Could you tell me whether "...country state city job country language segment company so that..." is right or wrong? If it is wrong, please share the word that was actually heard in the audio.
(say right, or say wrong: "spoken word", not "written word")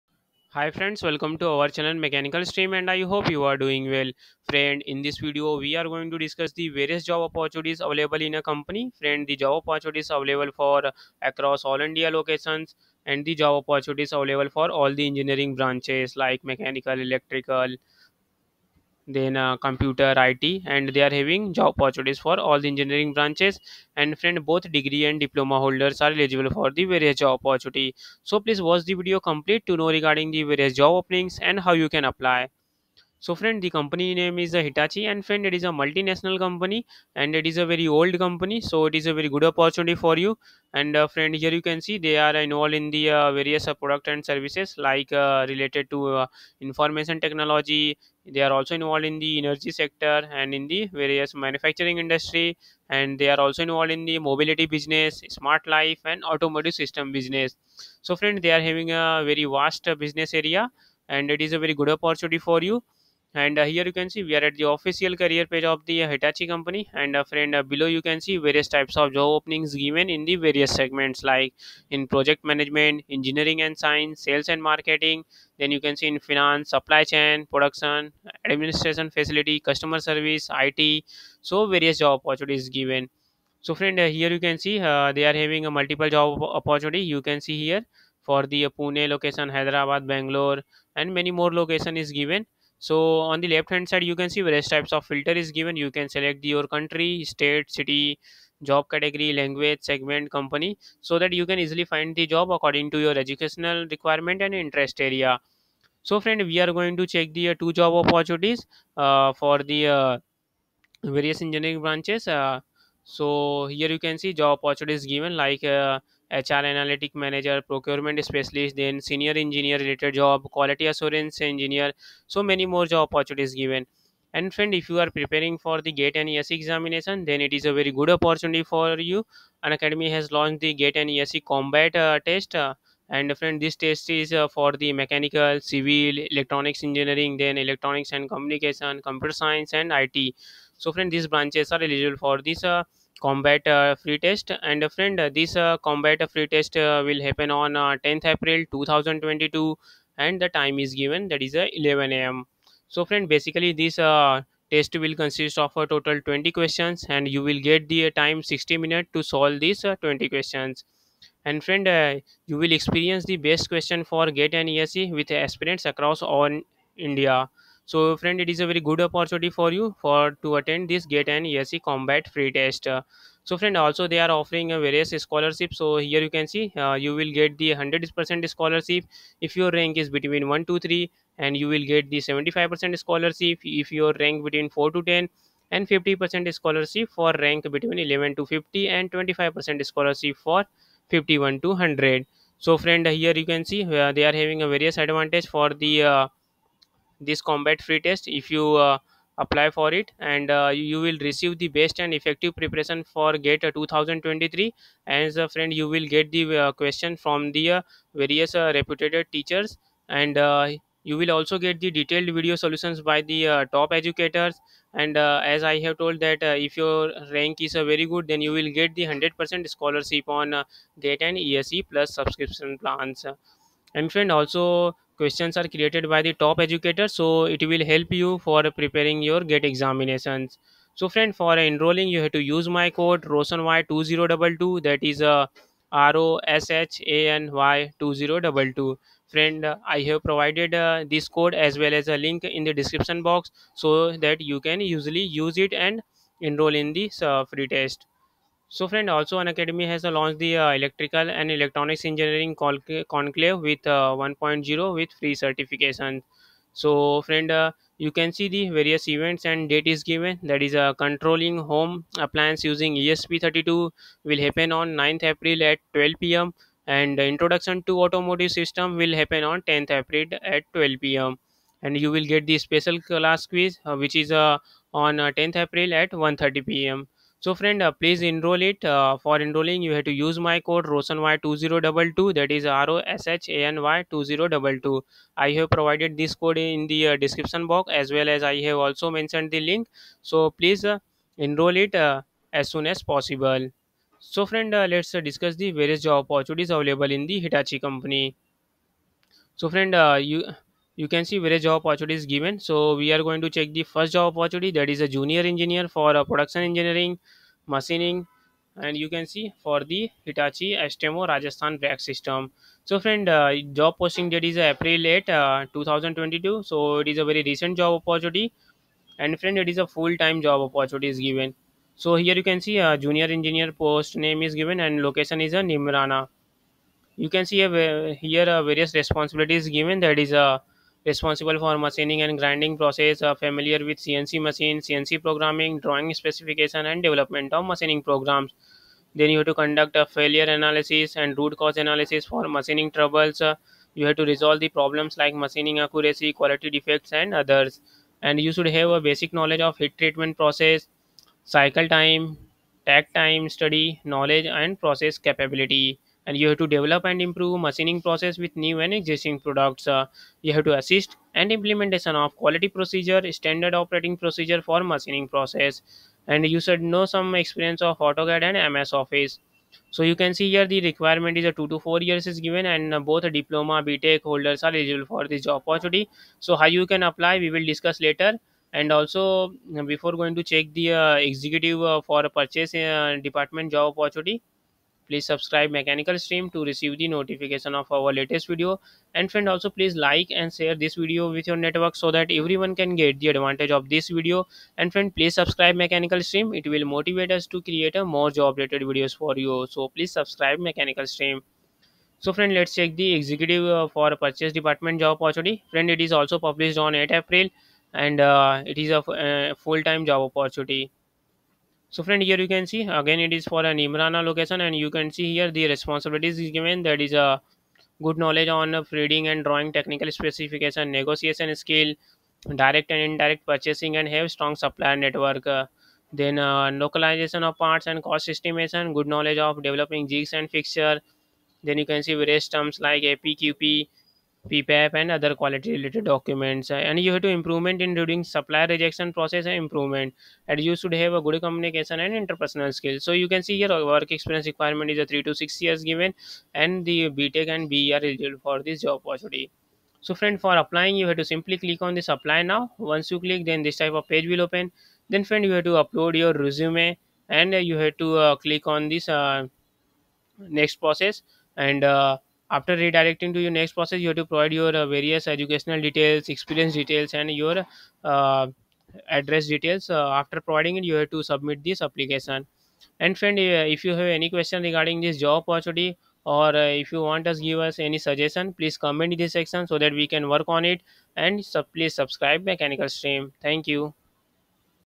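wrong: "category", not "country".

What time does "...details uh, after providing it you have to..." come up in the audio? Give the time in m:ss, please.
7:49.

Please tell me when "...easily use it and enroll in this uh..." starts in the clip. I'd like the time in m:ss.
4:04.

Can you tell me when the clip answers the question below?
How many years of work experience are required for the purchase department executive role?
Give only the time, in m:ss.
7:25.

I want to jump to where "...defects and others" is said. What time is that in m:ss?
5:46.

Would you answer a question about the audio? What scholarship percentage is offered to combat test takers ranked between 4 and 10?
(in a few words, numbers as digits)
75%.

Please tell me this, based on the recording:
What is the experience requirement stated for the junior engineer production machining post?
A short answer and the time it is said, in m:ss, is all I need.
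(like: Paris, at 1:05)
2 to 4 years, at 6:11.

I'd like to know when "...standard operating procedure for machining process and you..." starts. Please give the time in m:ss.
6:03.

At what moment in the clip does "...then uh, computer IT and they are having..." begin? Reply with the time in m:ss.
0:19.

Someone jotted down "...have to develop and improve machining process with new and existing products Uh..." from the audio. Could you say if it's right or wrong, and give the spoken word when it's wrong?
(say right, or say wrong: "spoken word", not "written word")
right.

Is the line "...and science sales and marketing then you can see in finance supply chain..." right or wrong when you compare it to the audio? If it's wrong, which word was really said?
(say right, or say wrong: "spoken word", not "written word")
right.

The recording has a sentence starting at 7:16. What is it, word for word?
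Uh, and you have to improvement in during supplier rejection process and improvement.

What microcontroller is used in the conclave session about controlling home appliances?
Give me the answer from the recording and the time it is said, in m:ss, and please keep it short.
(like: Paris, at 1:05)
ESP32, at 4:22.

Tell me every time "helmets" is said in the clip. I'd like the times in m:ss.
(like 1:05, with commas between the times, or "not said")
not said.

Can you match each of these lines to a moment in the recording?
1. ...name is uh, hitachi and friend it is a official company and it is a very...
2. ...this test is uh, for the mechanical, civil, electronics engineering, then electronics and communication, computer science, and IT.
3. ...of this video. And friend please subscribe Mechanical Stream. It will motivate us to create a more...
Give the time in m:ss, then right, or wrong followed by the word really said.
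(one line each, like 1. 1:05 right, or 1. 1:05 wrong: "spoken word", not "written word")
1. 0:34 wrong: "multinational", not "official"
2. 2:13 right
3. 6:33 right.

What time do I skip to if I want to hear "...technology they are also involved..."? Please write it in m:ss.
0:47.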